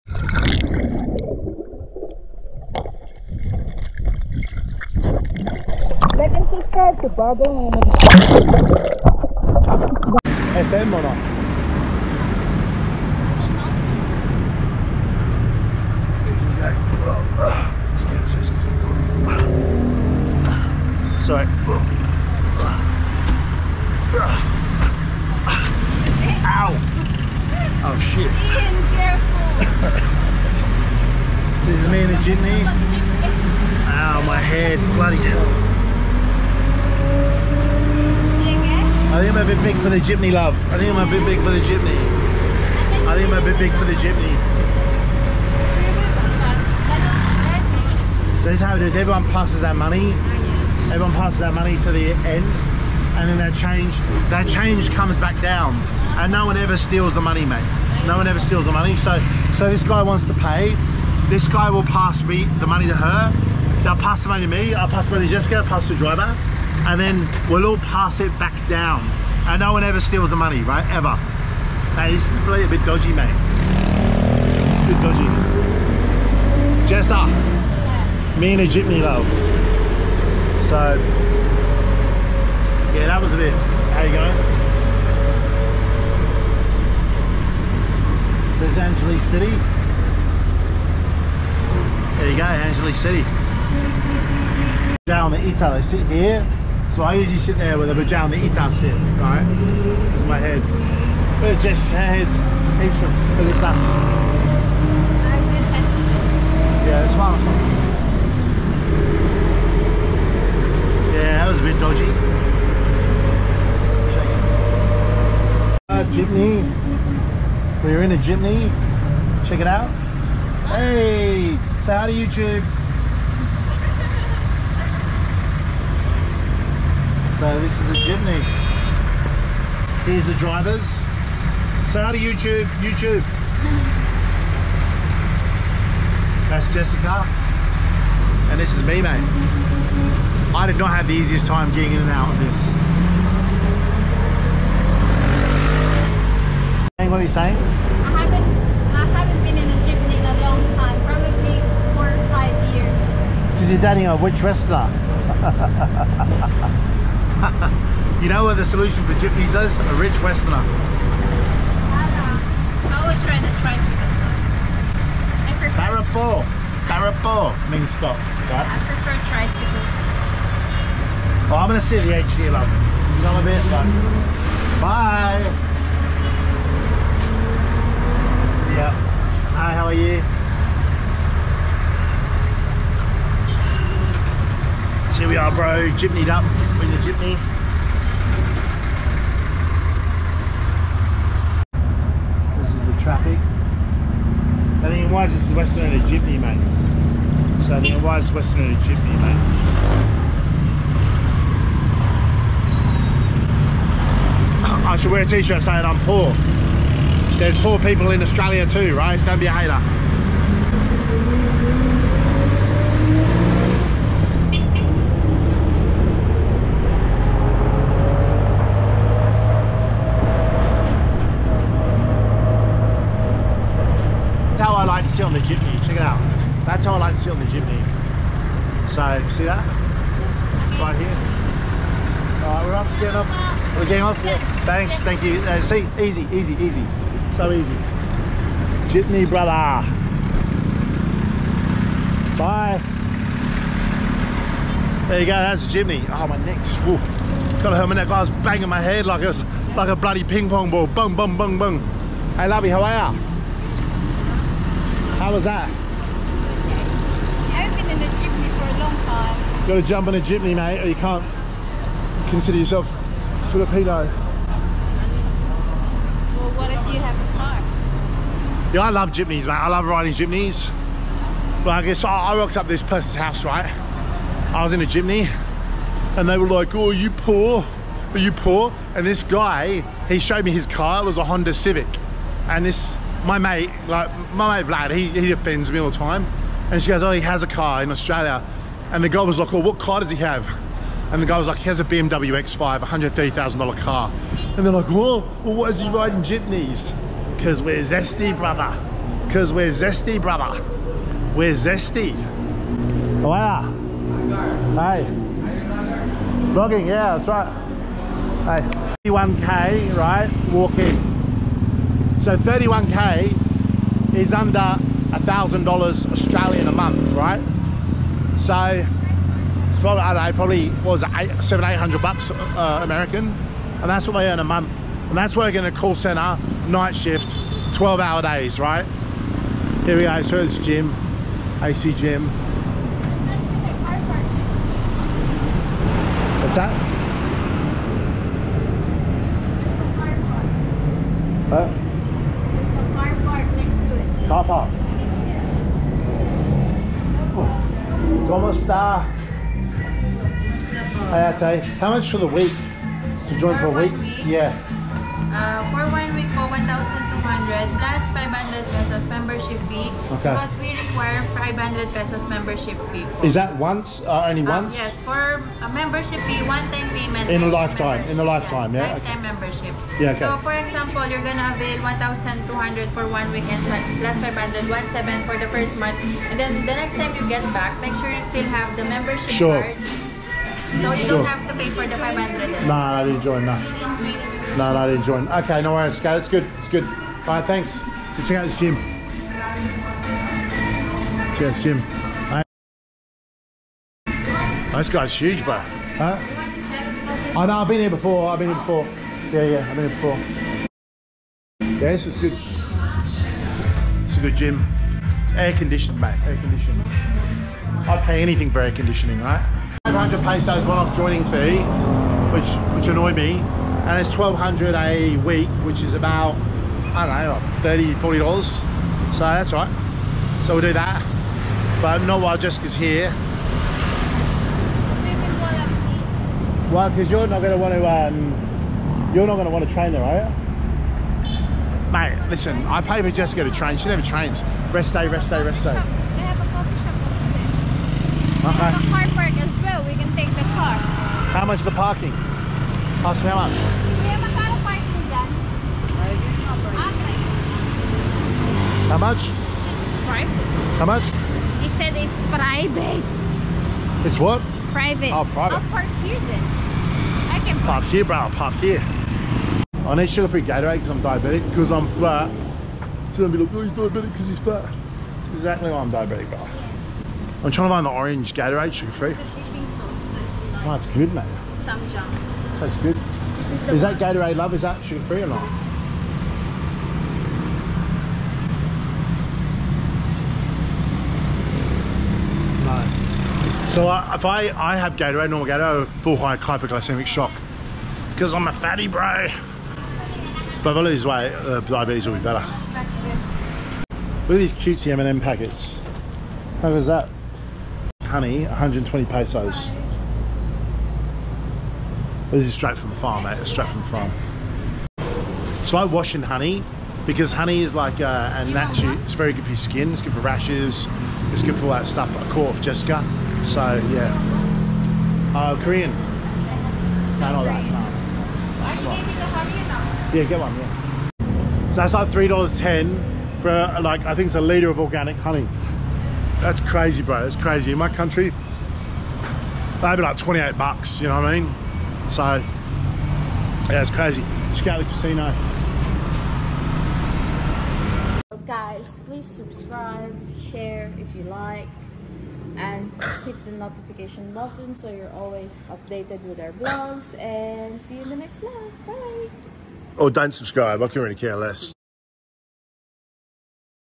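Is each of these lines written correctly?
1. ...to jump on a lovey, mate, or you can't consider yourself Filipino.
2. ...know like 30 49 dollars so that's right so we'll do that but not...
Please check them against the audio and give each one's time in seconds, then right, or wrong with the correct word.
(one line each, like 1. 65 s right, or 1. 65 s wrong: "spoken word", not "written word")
1. 259 s wrong: "jeepney", not "lovey"
2. 417 s wrong: "40", not "49".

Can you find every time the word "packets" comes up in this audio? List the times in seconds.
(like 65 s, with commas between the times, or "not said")
495 s.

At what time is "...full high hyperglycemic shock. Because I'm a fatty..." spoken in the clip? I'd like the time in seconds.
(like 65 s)
486 s.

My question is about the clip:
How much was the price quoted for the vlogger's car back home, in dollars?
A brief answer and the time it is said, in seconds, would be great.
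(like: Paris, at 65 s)
$130,000, at 292 s.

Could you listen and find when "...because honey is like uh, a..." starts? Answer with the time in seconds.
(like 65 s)
507 s.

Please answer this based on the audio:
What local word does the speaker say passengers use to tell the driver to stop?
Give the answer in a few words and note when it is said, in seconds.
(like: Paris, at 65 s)
Barapore, at 166 s.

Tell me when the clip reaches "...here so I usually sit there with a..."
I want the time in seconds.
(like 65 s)
96 s.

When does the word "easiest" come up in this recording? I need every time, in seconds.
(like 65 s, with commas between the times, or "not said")
141 s.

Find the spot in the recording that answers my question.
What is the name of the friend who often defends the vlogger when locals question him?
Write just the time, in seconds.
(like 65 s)
284 s.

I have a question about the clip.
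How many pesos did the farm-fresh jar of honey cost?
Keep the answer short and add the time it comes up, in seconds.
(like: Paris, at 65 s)
120 pesos, at 498 s.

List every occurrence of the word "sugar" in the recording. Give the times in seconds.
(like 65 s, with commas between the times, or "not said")
460 s, 468 s, 474 s.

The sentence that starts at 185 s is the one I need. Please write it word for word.
here we are, bro, jibnied up the jeepney.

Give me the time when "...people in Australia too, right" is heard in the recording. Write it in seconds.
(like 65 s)
207 s.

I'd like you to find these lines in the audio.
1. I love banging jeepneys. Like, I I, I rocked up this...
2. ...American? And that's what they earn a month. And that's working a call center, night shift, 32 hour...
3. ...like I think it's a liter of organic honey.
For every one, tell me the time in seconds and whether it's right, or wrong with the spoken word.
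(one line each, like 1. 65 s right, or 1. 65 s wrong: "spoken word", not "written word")
1. 269 s wrong: "riding", not "banging"
2. 322 s wrong: "12", not "32"
3. 523 s right.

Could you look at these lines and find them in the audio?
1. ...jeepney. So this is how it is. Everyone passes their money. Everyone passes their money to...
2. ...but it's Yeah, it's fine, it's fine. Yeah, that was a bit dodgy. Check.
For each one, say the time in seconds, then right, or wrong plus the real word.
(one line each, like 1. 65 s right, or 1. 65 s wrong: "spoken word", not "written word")
1. 43 s right
2. 103 s right.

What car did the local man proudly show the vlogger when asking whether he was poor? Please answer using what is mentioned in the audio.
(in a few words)
Honda Civic.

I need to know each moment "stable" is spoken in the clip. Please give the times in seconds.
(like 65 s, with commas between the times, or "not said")
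not said.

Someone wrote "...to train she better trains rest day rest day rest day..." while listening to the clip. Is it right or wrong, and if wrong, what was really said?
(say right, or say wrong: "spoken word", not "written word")
wrong: "never", not "better".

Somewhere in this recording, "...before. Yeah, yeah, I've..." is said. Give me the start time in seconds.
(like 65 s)
398 s.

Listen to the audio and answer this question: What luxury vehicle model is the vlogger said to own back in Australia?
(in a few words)
BMW X5.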